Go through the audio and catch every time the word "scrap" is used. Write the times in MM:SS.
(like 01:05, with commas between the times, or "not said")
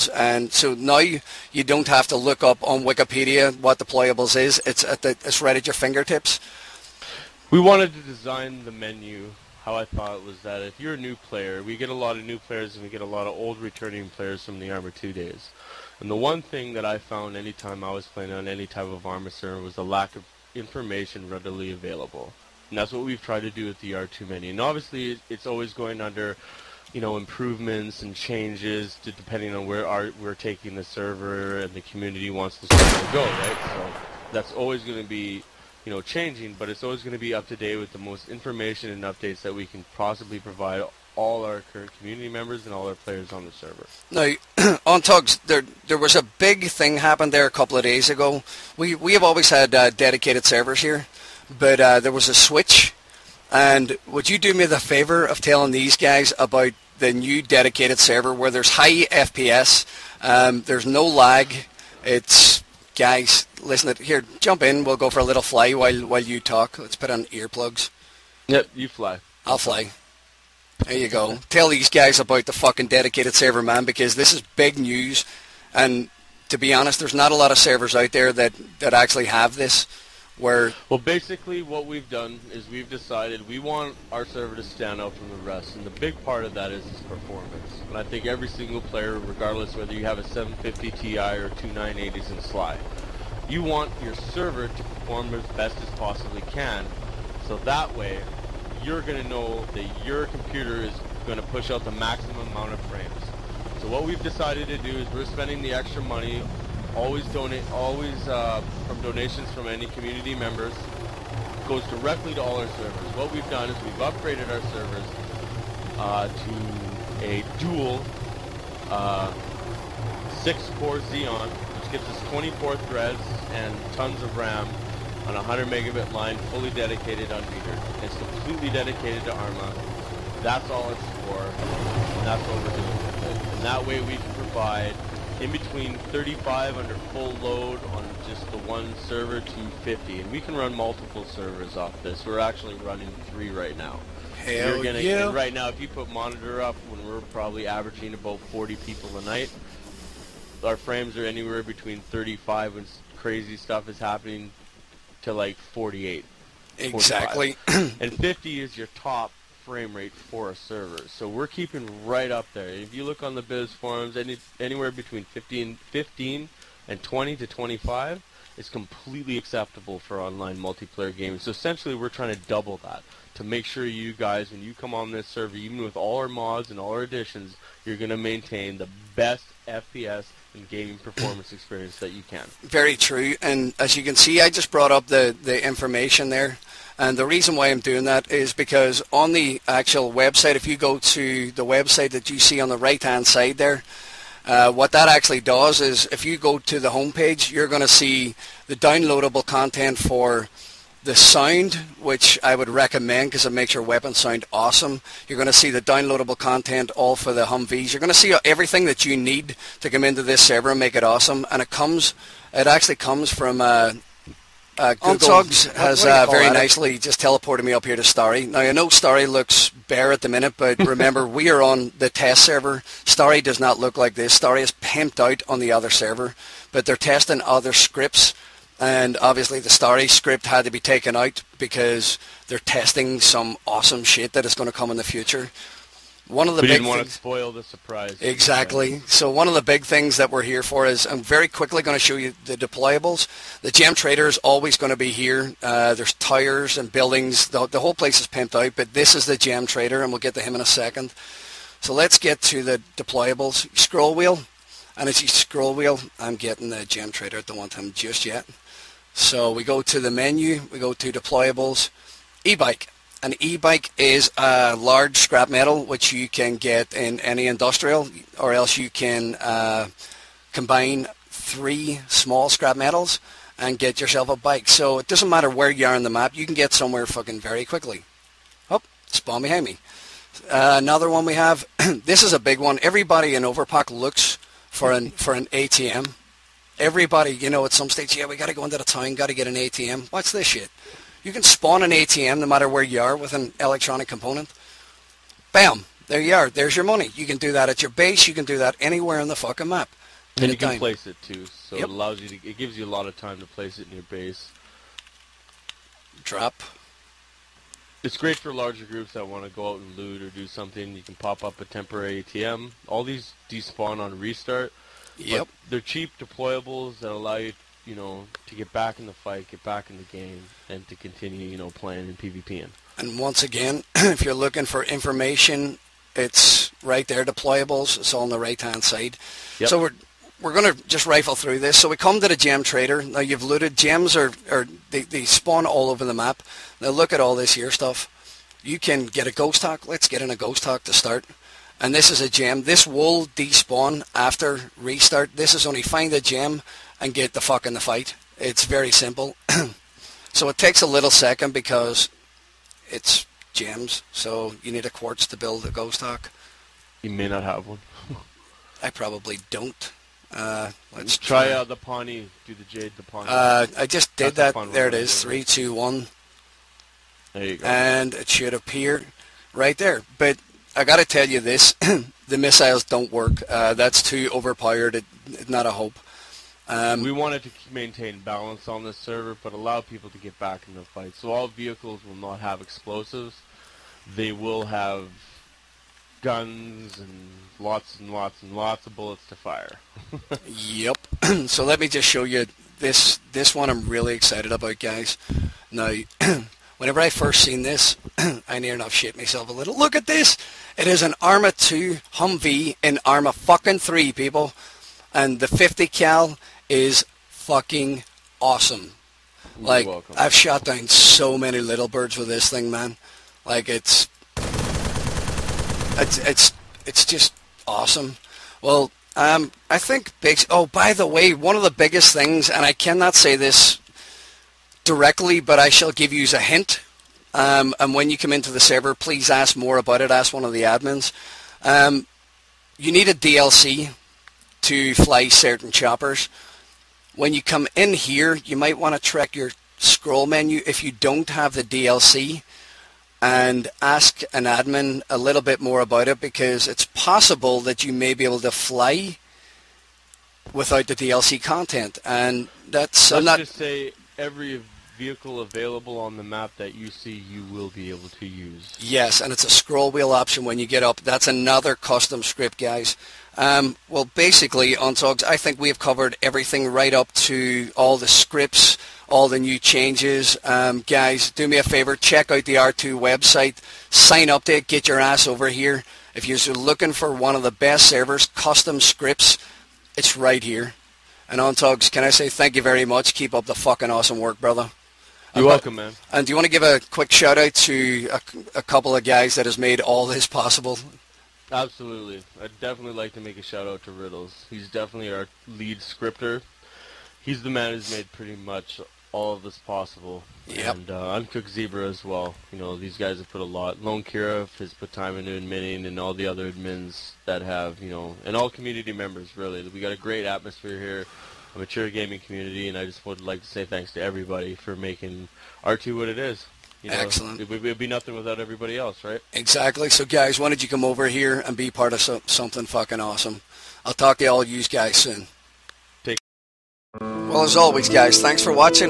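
04:25, 04:32.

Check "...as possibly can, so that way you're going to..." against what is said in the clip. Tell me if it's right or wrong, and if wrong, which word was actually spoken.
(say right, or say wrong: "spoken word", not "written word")
right.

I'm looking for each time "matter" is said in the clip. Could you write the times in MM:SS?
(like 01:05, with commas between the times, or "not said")
04:35, 04:52.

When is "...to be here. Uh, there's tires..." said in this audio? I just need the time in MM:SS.
04:04.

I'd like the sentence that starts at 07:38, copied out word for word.
Yes, and it's a scroll wheel option when you get up.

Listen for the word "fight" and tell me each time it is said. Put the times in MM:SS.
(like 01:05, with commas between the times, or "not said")
05:19, 05:47, 06:20.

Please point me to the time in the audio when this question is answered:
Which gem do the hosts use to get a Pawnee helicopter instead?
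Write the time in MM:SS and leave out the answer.
06:02.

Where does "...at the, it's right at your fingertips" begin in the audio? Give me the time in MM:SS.
00:04.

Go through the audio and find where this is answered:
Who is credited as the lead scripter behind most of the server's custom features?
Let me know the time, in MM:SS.
08:13.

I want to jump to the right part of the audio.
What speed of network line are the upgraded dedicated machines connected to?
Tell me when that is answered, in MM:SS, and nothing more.
02:05.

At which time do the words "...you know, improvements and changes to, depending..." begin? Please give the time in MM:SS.
00:26.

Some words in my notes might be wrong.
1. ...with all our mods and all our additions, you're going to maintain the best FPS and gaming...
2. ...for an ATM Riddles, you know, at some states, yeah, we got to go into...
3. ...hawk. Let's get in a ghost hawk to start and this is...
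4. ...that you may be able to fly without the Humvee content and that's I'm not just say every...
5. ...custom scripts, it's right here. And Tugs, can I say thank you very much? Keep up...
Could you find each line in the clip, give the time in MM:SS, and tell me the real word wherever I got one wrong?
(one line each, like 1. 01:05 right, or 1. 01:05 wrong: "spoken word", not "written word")
1. 02:55 right
2. 04:45 wrong: "Everybody", not "Riddles"
3. 05:39 right
4. 07:27 wrong: "DLC", not "Humvee"
5. 07:58 wrong: "Untugs", not "Tugs".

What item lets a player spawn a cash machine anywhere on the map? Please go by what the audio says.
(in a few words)
Electronic component.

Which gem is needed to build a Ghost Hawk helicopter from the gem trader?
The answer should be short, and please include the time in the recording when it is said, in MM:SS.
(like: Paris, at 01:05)
Quartz, at 05:54.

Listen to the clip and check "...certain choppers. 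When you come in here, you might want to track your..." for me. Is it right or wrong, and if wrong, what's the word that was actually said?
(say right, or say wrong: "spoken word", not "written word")
right.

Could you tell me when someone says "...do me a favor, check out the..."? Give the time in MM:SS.
07:51.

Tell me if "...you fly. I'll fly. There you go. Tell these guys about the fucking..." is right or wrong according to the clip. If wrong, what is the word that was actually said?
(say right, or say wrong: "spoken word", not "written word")
right.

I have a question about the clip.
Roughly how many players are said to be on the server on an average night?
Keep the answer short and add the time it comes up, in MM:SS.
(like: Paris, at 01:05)
40, at 02:28.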